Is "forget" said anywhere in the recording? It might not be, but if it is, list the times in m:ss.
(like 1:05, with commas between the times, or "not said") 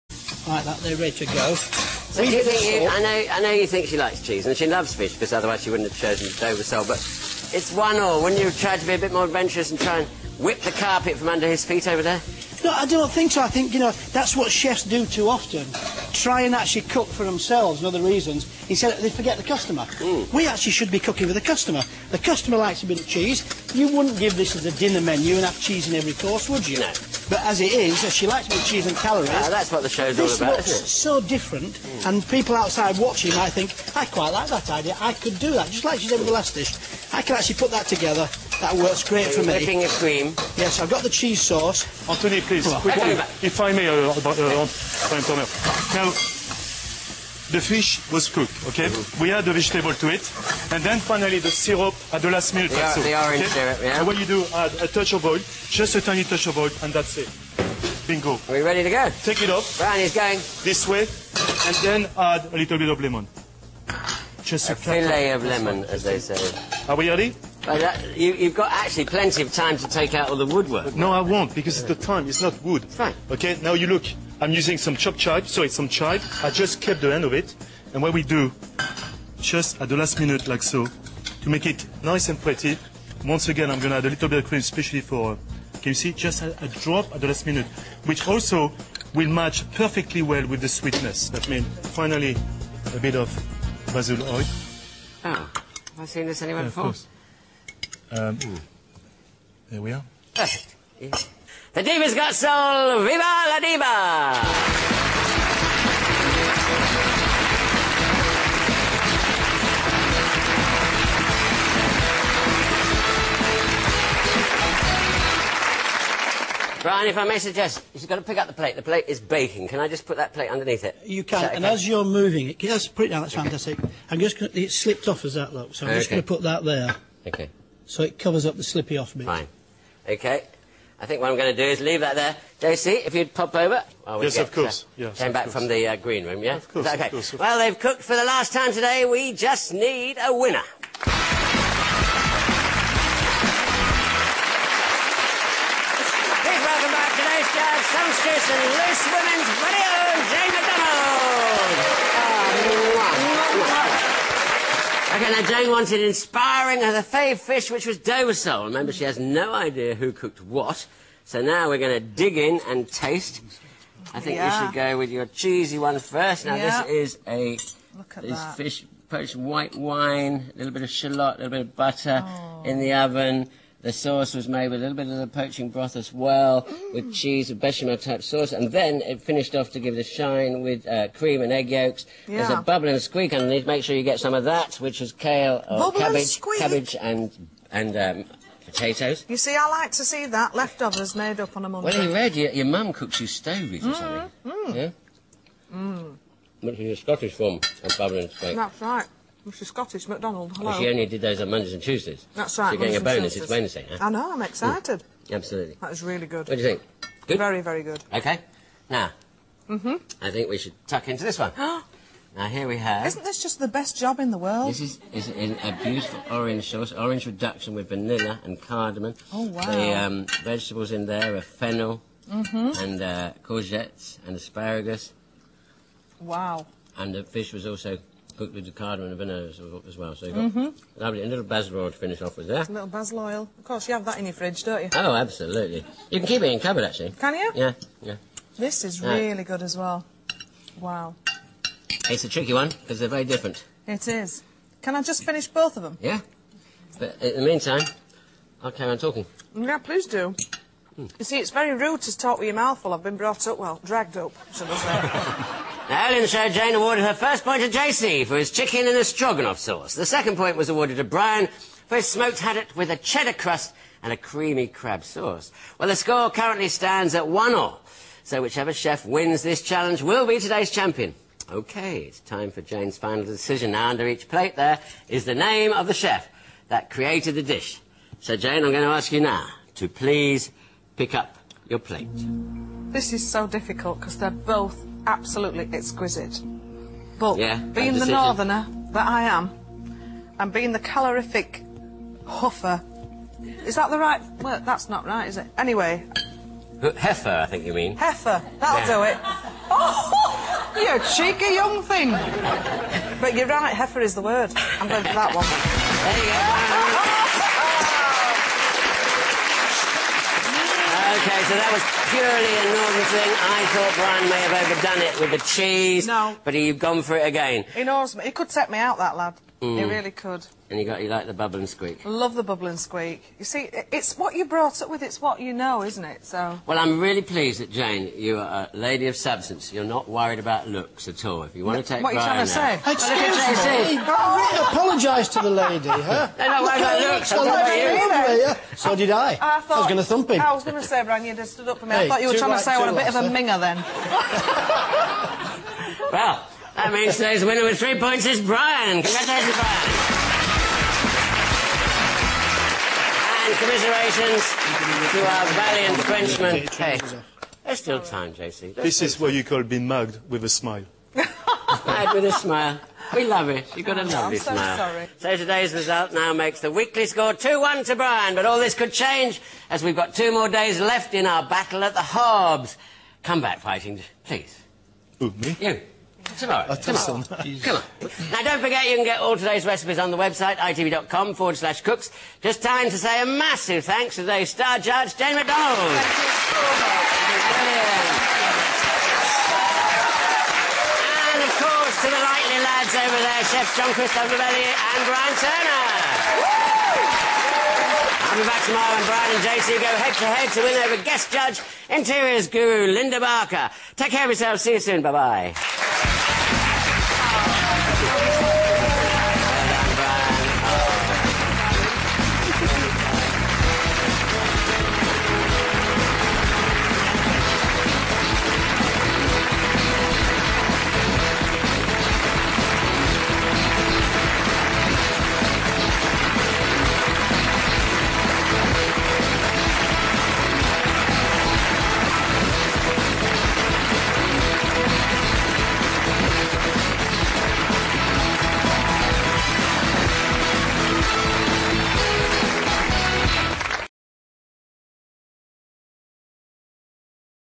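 0:19, 6:18.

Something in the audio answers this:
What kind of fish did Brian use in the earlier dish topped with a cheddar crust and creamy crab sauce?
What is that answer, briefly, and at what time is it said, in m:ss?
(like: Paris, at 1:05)
Smoked haddock, at 4:22.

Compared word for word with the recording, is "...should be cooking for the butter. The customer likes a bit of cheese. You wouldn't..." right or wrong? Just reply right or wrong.
wrong.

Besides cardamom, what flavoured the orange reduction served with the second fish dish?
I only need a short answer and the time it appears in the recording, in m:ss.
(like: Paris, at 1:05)
Vanilla, at 3:37.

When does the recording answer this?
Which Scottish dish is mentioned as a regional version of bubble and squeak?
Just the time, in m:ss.
3:13.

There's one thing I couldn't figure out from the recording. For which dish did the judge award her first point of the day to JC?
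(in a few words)
Chicken in a stroganoff sauce.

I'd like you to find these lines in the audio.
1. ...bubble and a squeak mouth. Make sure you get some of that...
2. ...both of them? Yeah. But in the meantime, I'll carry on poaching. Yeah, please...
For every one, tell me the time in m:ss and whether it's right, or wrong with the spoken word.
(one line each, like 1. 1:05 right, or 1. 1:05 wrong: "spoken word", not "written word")
1. 3:02 wrong: "underneath", not "mouth"
2. 4:05 wrong: "talking", not "poaching".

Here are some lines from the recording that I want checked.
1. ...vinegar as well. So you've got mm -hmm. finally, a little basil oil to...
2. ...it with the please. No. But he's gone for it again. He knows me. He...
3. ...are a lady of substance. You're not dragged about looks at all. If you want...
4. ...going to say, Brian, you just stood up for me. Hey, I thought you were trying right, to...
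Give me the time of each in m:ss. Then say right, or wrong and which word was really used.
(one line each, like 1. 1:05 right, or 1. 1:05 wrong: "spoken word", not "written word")
1. 3:49 wrong: "lovely", not "finally"
2. 5:15 wrong: "cheese", not "please"
3. 5:28 wrong: "worried", not "dragged"
4. 5:40 right.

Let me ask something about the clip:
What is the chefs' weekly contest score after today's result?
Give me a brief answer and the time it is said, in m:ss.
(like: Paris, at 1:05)
2-1, at 6:07.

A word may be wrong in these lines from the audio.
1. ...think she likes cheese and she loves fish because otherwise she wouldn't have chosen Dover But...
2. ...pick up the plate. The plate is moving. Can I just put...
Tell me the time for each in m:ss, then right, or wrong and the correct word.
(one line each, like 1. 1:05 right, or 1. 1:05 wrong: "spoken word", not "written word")
1. 0:03 right
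2. 1:58 wrong: "baking", not "moving".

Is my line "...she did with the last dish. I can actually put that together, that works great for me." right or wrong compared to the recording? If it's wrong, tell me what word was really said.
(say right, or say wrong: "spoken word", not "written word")
right.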